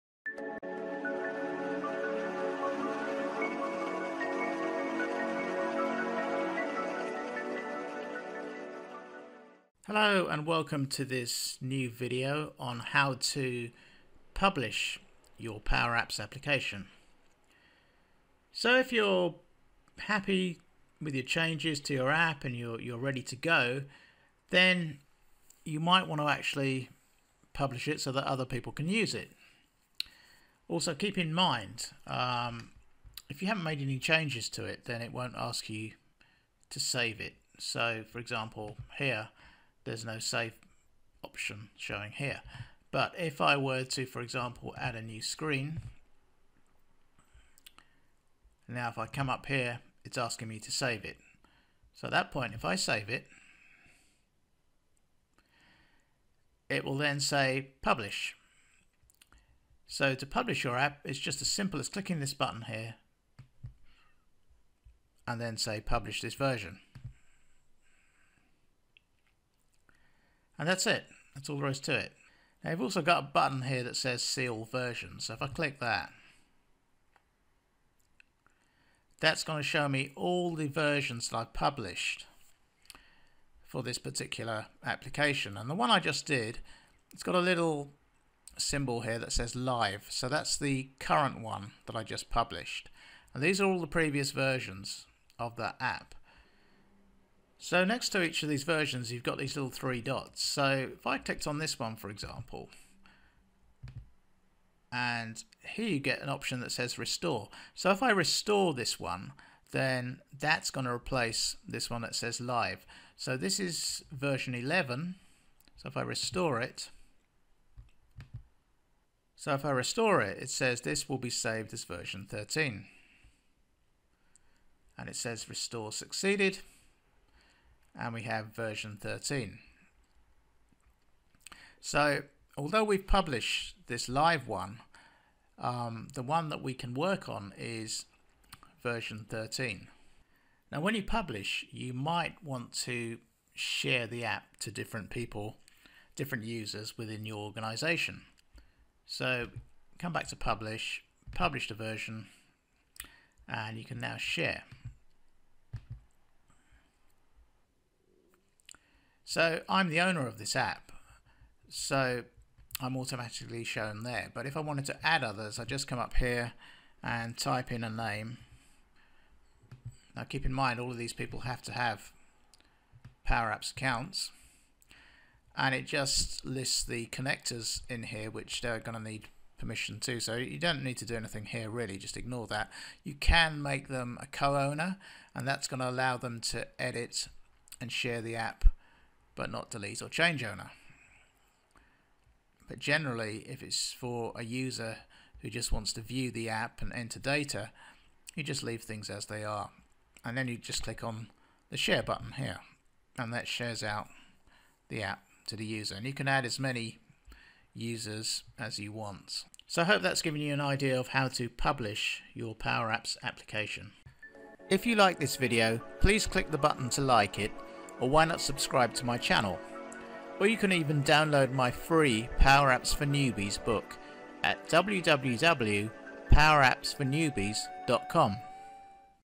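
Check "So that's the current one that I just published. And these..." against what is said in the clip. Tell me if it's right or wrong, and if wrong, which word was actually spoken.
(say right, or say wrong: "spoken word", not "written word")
right.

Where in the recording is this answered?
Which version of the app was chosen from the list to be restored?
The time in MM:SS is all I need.
01:54.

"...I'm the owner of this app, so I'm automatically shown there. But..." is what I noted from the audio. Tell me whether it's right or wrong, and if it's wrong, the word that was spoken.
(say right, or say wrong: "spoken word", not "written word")
right.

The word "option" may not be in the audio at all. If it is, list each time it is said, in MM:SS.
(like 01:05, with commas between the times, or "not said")
00:41, 01:46.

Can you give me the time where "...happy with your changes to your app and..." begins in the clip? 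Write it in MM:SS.
00:19.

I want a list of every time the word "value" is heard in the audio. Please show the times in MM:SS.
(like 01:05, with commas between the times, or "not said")
not said.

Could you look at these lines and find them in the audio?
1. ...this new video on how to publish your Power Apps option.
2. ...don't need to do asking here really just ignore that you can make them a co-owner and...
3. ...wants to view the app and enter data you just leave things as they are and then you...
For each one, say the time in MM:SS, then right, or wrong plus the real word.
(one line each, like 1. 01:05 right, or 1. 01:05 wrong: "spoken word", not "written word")
1. 00:11 wrong: "application", not "option"
2. 03:00 wrong: "anything", not "asking"
3. 03:15 right.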